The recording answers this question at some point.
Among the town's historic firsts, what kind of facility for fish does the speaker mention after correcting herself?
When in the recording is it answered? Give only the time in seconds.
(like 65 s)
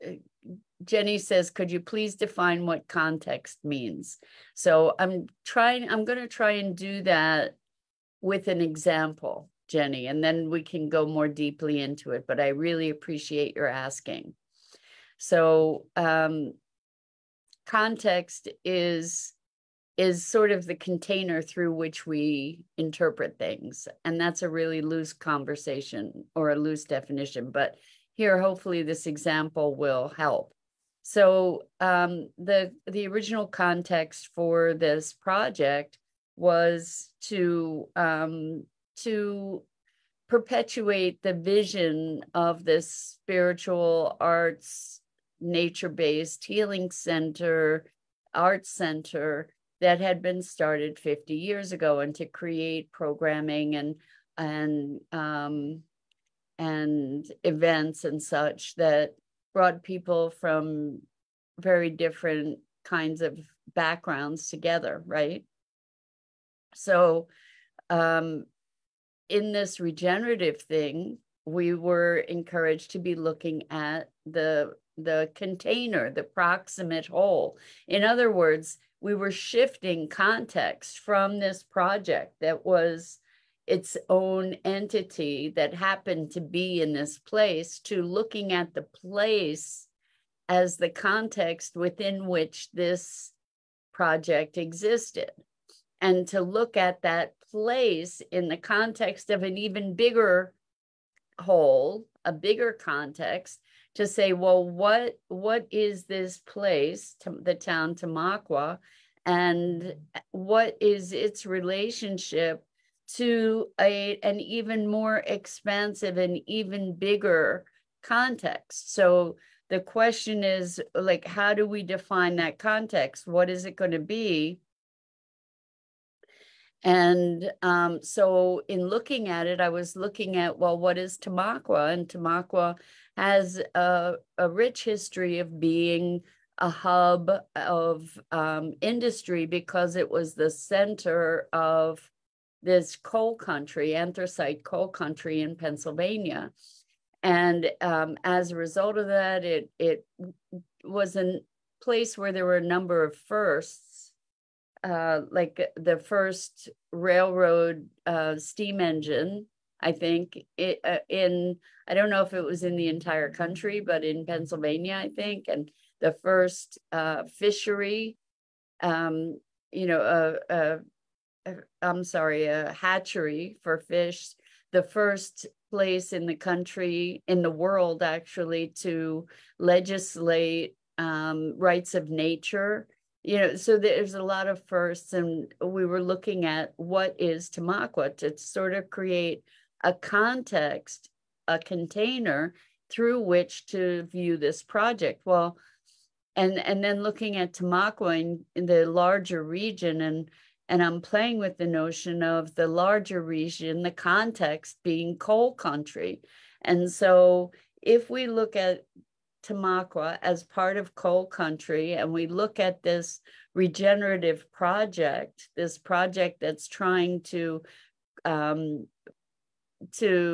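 172 s.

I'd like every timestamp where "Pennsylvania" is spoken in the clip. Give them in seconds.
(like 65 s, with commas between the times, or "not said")
145 s, 164 s.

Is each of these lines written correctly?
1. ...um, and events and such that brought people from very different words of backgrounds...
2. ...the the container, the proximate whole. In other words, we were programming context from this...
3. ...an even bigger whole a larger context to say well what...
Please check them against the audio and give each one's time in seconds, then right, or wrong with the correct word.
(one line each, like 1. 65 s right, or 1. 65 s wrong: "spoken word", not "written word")
1. 55 s wrong: "kinds", not "words"
2. 74 s wrong: "shifting", not "programming"
3. 99 s wrong: "bigger", not "larger".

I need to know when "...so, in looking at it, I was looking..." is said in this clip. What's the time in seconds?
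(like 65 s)
128 s.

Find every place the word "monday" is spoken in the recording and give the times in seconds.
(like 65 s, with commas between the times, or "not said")
not said.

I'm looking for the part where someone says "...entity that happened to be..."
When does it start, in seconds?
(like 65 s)
84 s.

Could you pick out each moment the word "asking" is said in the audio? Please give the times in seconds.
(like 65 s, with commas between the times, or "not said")
13 s.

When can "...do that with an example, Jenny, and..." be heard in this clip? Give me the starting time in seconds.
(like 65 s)
6 s.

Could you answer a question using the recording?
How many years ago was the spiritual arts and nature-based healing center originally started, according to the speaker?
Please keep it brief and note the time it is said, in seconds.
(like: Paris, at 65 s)
50 years, at 50 s.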